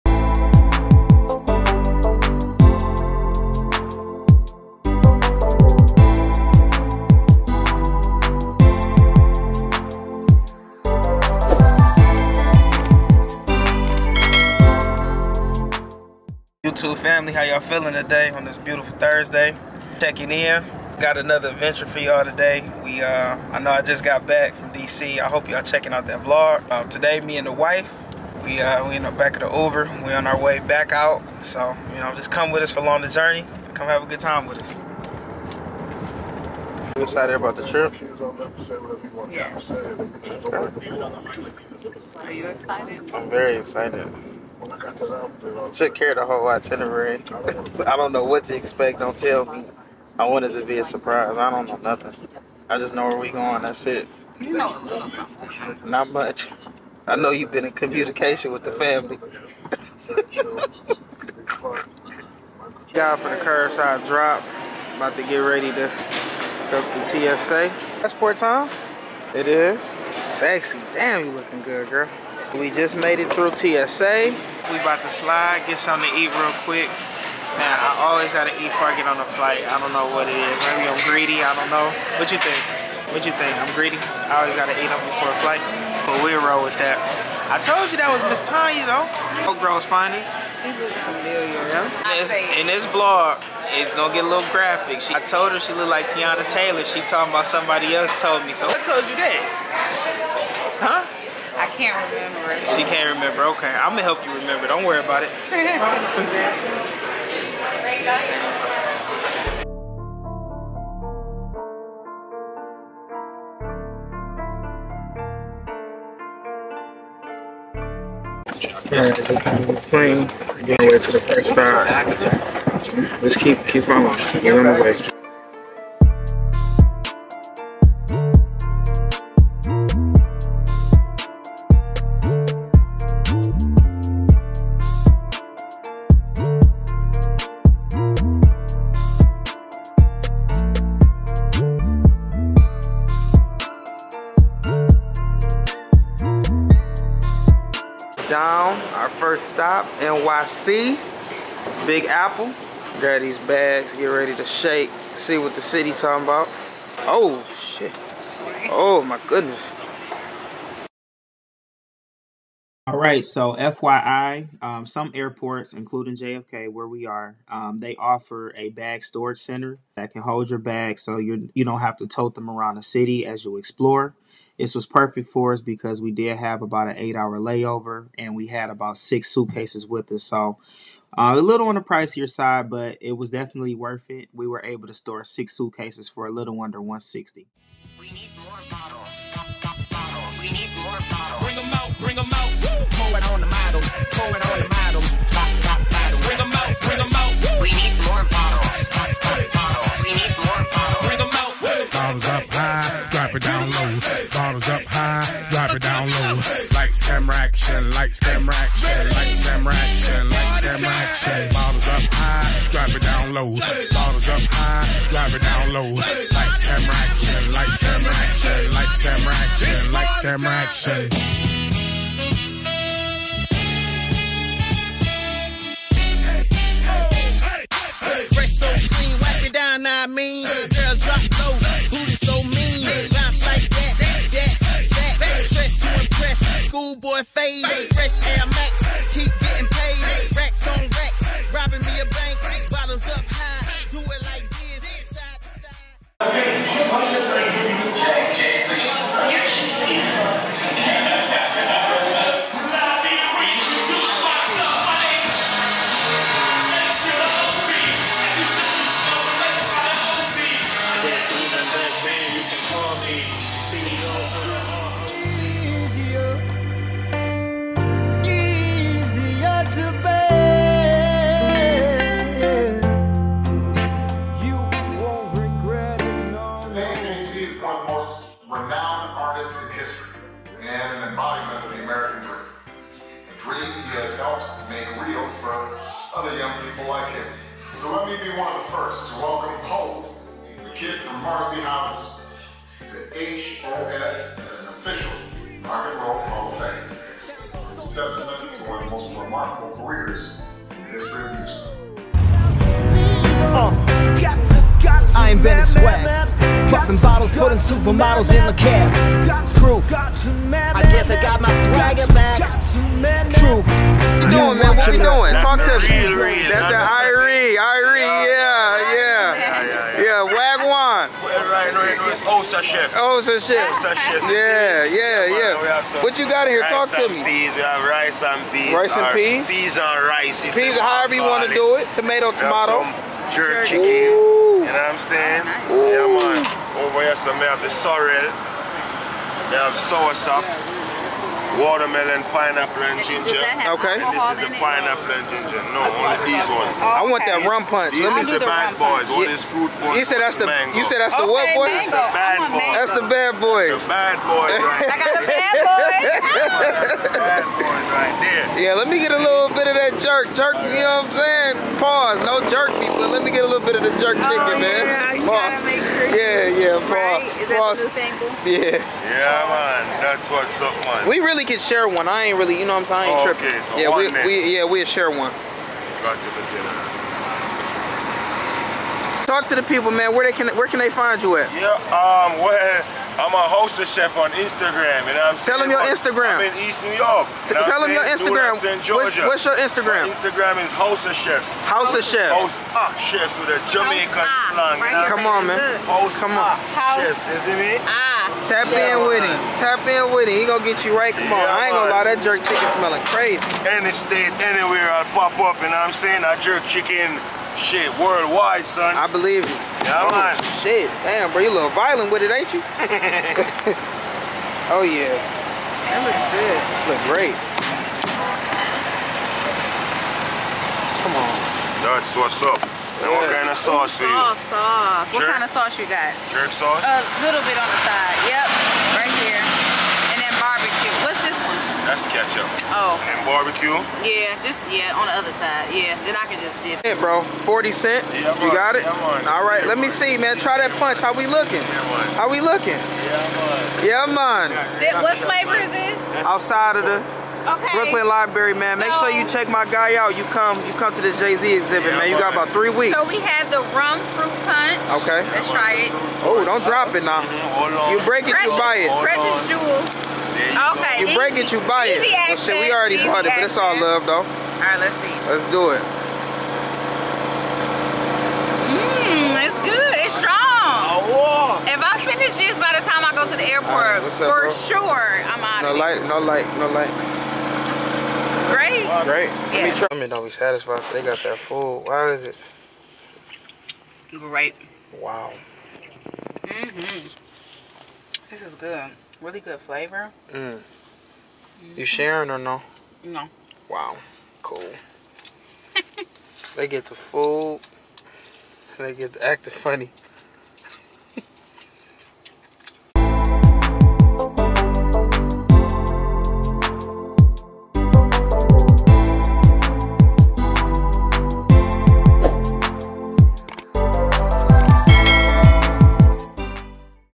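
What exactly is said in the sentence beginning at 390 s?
My Instagram is host of chefs.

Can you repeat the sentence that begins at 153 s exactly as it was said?
Grab these bags, get ready to shake, see what the city talking about.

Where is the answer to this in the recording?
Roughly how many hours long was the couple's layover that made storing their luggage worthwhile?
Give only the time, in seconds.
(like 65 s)
176 s.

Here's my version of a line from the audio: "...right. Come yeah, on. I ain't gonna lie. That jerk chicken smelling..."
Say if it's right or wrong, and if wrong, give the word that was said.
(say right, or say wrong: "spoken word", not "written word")
right.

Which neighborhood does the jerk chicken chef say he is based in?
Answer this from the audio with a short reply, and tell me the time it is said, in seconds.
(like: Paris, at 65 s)
East New York, at 386 s.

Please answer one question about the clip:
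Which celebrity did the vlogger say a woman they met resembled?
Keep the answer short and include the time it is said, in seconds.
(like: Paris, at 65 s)
Teyana Taylor, at 96 s.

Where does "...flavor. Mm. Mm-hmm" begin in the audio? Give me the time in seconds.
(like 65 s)
489 s.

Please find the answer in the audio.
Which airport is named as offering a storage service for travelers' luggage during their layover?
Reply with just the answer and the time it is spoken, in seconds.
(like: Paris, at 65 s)
JFK, at 166 s.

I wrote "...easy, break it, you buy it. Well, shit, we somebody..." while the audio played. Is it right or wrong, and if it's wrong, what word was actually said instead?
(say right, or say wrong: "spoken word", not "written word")
wrong: "already", not "somebody".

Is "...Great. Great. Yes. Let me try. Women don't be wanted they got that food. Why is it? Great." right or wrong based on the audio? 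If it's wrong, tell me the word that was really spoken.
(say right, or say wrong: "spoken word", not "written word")
wrong: "satisfied", not "wanted".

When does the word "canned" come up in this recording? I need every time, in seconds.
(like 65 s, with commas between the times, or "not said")
not said.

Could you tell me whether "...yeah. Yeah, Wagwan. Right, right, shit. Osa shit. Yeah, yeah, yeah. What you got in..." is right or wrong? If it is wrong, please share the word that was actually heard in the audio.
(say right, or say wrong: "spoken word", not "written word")
right.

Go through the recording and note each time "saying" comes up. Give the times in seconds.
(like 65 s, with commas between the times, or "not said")
334 s, 361 s, 372 s, 405 s.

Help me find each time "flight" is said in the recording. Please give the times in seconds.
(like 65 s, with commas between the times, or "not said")
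79 s, 85 s.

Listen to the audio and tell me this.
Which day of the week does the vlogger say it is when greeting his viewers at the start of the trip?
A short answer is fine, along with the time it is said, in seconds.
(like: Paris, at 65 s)
Thursday, at 18 s.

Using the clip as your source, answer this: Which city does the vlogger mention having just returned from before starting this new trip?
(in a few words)
DC.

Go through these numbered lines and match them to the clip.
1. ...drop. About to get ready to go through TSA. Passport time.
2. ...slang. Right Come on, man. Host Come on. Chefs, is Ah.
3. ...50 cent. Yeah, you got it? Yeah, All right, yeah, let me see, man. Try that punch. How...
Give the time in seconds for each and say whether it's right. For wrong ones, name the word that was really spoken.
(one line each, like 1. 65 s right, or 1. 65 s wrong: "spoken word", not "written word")
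1. 64 s right
2. 394 s right
3. 437 s wrong: "40", not "50".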